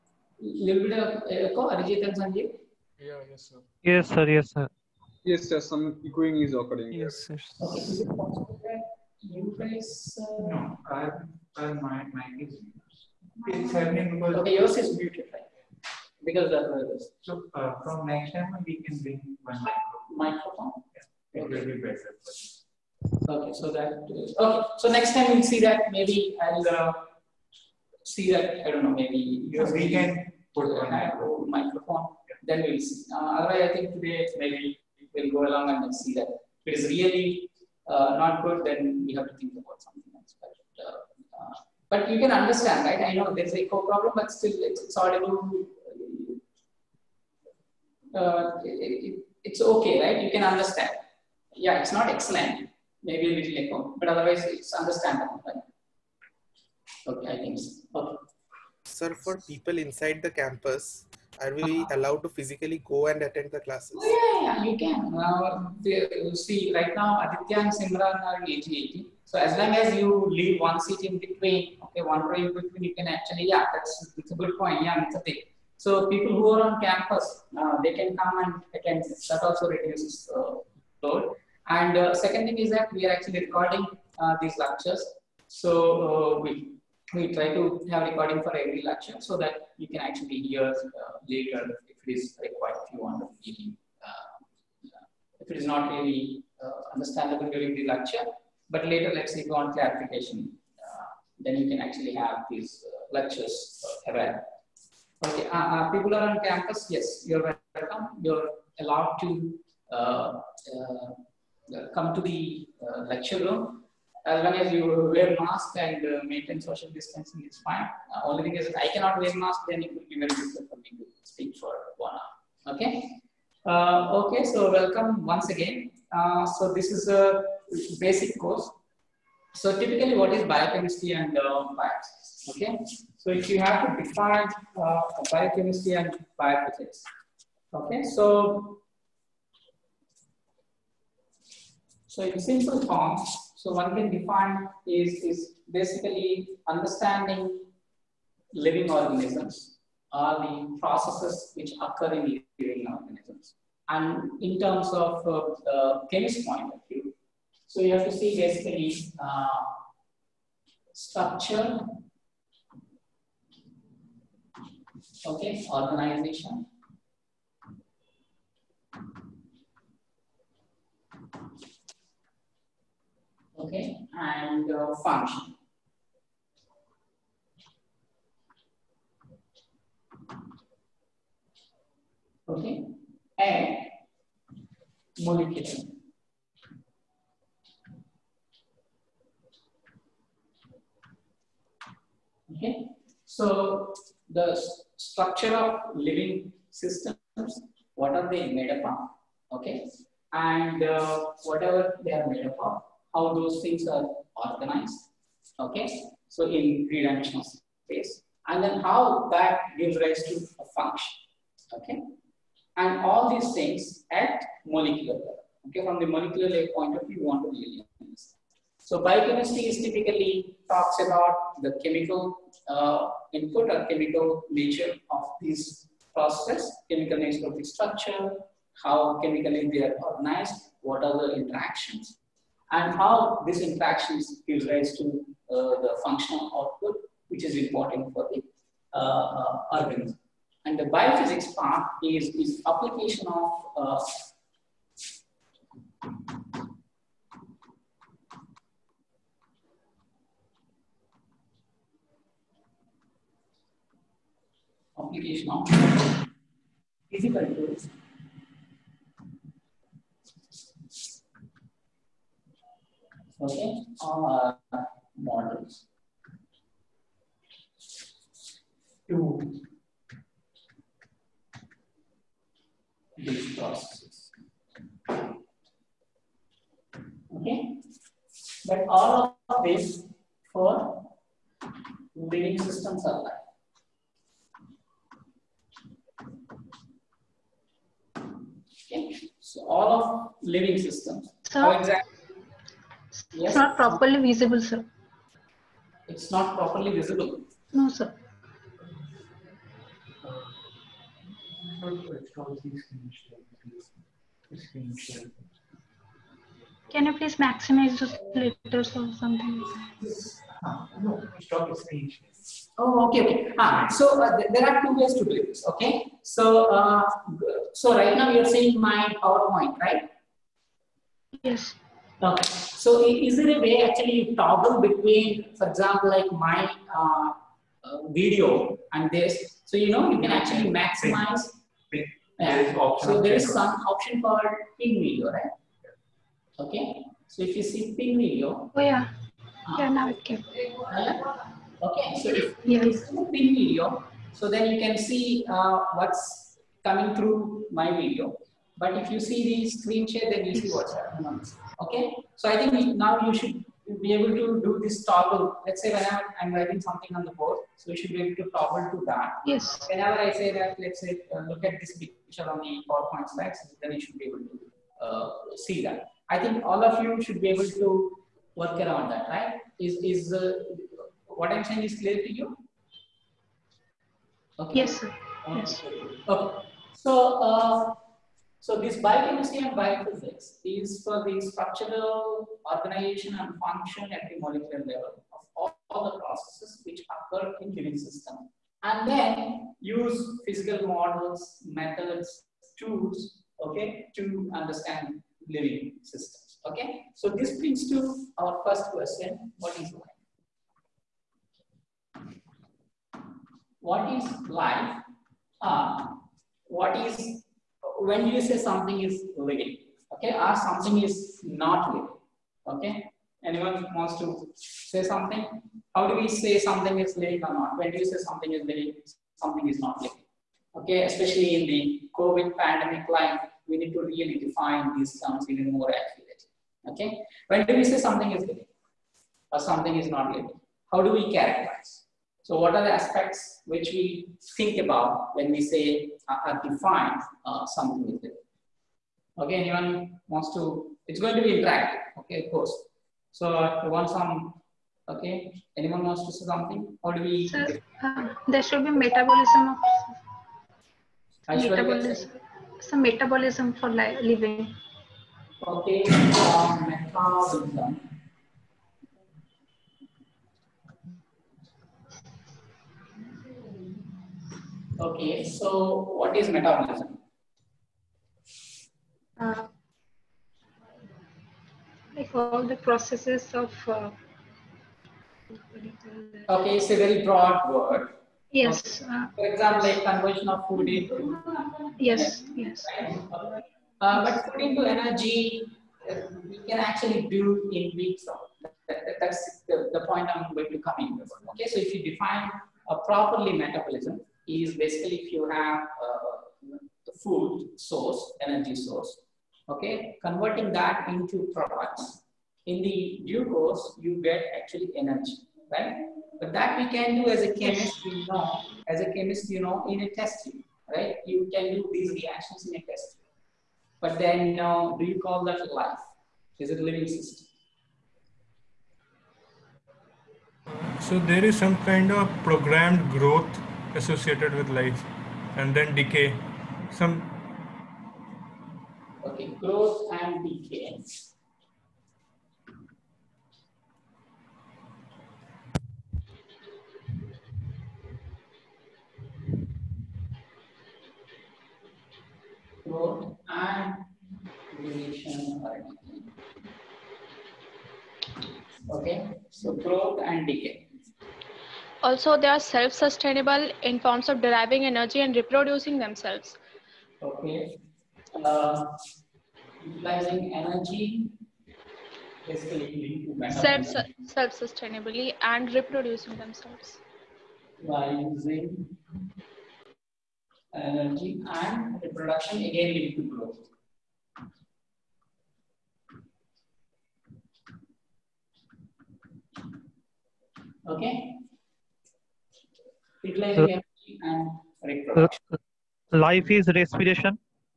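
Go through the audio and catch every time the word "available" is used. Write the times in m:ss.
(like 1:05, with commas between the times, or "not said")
1:44.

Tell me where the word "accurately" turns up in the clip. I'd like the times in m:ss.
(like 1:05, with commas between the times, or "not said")
7:05.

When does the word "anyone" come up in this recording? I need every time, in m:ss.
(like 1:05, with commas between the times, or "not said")
6:53, 7:19, 7:25.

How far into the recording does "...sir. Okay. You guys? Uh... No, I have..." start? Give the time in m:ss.
0:07.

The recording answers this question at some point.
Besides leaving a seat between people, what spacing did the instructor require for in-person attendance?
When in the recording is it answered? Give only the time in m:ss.
1:12.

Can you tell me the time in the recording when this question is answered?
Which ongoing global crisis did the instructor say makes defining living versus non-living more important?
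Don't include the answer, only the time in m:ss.
7:02.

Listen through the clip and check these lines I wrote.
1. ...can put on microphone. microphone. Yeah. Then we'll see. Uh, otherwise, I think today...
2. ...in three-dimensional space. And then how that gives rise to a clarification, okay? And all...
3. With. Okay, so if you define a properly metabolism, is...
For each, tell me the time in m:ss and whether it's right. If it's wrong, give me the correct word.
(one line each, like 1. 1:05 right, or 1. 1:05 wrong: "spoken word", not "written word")
1. 0:29 right
2. 3:26 wrong: "function", not "clarification"
3. 8:11 right.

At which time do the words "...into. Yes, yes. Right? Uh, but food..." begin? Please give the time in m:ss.
8:00.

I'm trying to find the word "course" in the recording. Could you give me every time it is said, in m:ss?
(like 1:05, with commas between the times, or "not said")
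2:08, 7:22, 8:23.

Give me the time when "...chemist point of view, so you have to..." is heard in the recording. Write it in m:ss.
2:36.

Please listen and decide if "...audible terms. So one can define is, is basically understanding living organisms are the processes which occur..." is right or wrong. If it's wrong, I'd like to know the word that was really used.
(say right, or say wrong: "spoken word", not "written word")
wrong: "simple", not "audible".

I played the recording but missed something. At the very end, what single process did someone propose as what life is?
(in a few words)
Respiration.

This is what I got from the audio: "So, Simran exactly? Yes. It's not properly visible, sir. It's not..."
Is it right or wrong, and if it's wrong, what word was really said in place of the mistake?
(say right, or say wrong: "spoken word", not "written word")
wrong: "How", not "Simran".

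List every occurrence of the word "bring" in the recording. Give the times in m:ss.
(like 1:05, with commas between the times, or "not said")
0:18, 6:37.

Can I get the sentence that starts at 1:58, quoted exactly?
Uh, only thing is if I cannot wear mask, then it will be very difficult for me to speak for one hour.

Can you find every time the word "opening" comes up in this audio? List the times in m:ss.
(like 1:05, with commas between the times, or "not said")
not said.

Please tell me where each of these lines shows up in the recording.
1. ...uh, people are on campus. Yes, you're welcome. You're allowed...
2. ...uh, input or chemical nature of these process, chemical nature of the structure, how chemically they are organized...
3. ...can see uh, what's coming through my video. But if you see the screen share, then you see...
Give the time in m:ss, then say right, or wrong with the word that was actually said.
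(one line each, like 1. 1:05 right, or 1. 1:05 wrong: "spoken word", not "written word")
1. 1:45 right
2. 3:42 right
3. 5:44 right.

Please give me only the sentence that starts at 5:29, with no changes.
So you know you can actually maximize.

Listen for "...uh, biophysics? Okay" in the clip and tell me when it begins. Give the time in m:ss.
2:11.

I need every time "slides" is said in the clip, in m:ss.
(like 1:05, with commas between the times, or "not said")
6:03.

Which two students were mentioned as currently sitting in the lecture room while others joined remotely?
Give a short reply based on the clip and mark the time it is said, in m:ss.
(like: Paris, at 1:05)
Aditya and Simran, at 1:07.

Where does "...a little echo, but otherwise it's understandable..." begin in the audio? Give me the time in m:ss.
0:53.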